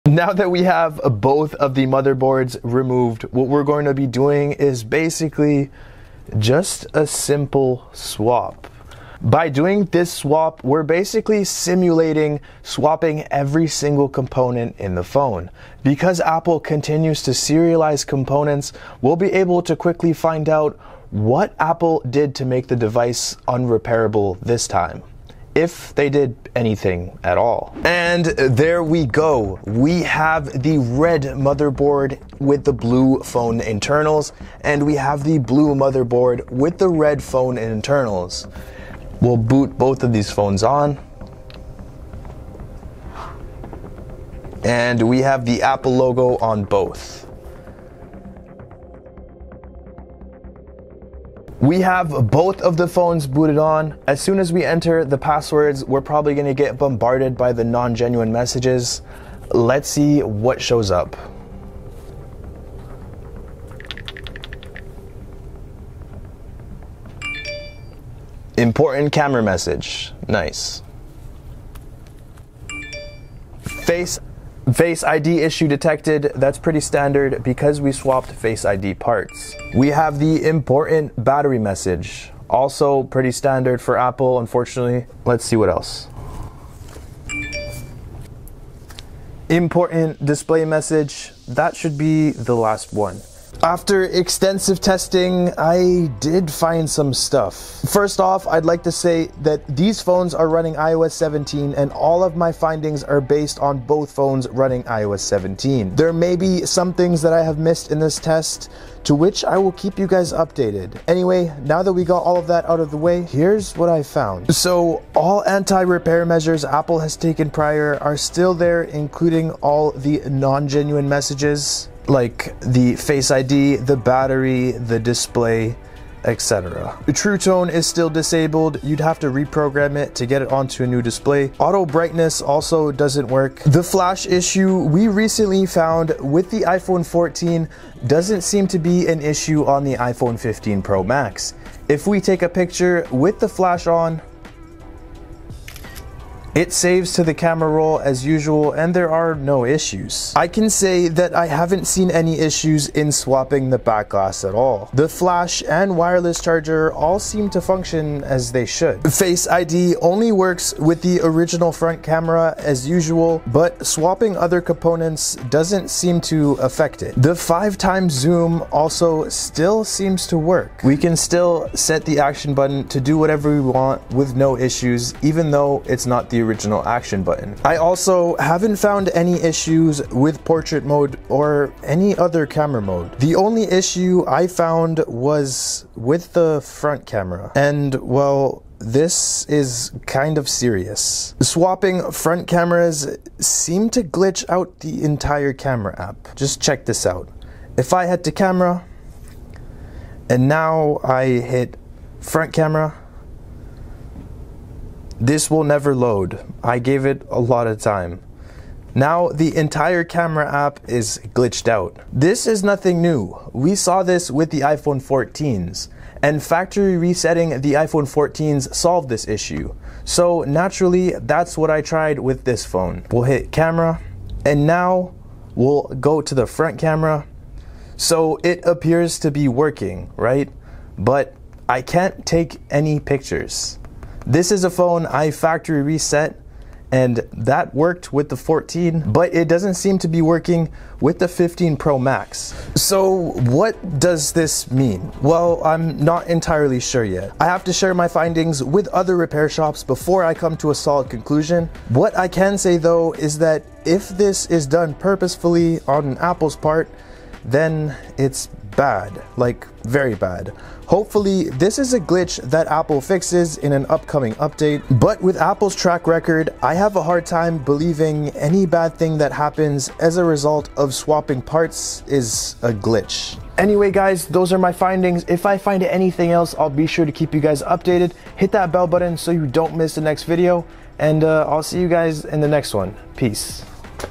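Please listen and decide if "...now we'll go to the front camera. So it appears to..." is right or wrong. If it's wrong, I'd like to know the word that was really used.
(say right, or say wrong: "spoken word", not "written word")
right.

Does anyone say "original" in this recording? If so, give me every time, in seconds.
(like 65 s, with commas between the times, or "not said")
161 s, 176 s.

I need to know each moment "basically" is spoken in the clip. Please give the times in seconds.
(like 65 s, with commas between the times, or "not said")
4 s, 10 s.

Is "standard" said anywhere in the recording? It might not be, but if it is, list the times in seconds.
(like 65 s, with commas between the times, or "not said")
76 s, 83 s.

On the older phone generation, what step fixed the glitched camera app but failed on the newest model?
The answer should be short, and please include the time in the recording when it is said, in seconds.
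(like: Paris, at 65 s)
Factory resetting, at 216 s.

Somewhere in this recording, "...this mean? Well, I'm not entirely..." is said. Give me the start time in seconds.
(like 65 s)
244 s.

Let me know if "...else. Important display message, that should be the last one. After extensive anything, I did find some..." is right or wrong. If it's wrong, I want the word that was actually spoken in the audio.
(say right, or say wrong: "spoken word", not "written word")
wrong: "testing", not "anything".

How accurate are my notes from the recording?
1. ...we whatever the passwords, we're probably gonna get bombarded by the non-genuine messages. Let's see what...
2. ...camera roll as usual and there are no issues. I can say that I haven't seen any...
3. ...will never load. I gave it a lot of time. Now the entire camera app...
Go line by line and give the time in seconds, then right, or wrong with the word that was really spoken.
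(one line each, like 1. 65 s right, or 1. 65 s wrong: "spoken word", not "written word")
1. 54 s wrong: "enter", not "whatever"
2. 147 s right
3. 205 s right.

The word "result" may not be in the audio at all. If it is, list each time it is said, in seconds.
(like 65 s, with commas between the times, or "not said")
270 s.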